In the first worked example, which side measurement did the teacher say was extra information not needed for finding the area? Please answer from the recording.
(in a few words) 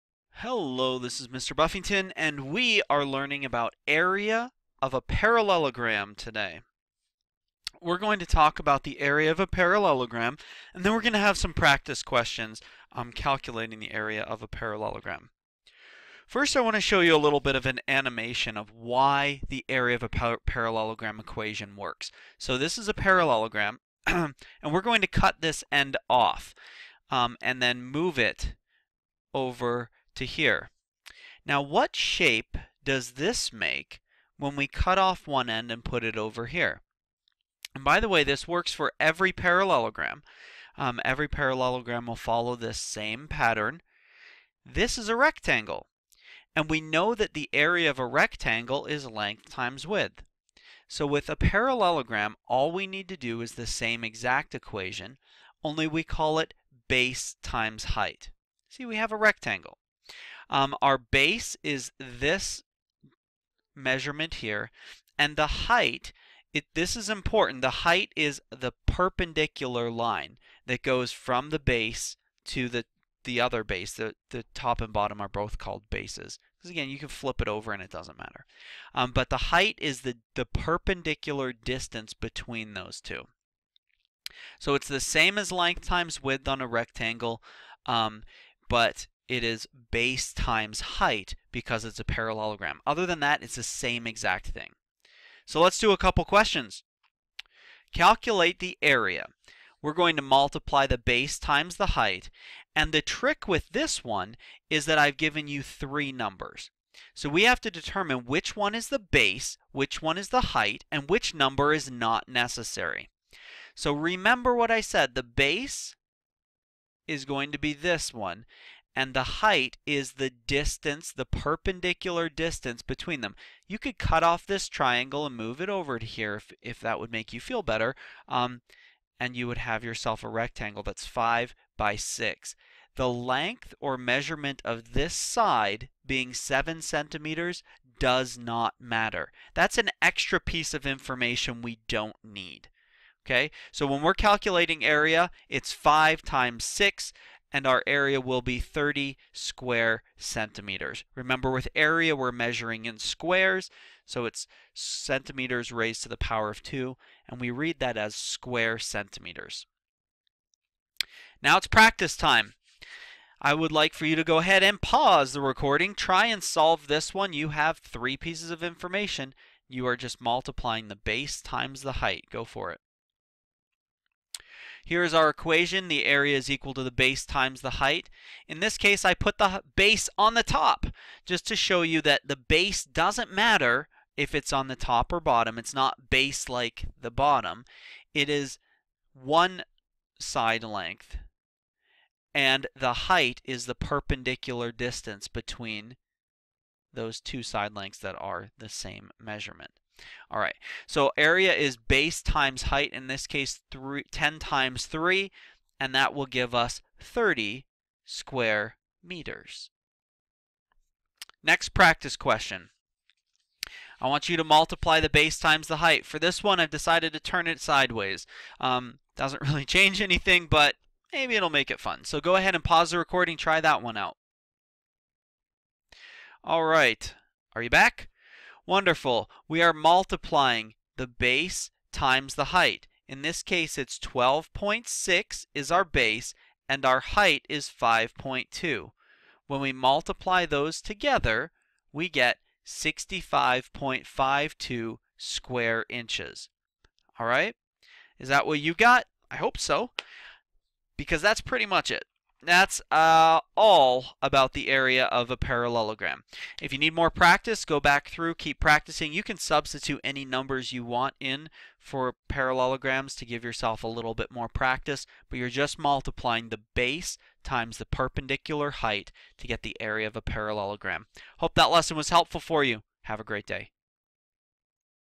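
7 centimeters.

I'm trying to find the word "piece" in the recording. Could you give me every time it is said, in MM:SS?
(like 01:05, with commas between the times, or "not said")
02:20, 02:48.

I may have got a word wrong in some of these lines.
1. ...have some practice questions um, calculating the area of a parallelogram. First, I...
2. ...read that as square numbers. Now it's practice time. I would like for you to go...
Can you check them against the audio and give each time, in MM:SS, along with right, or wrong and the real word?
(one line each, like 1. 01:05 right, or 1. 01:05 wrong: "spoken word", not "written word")
1. 00:11 right
2. 02:37 wrong: "centimeters", not "numbers".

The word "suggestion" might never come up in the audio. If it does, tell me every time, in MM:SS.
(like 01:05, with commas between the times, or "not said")
not said.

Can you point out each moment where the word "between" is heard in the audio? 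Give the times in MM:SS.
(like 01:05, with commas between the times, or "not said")
01:22, 02:02, 03:15.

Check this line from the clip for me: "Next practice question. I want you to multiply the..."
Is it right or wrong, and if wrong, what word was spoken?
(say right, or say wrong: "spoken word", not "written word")
right.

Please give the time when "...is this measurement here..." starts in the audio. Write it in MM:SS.
01:01.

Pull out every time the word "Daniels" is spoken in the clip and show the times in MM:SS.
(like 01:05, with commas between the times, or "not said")
not said.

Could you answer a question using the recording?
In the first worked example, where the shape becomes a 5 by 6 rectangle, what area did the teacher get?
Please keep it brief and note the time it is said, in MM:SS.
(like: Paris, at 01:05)
30 square centimeters, at 02:28.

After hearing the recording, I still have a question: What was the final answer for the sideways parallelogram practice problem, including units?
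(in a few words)
65.52 square inches.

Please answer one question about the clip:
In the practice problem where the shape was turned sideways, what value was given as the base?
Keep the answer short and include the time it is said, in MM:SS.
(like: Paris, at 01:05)
12.6, at 03:53.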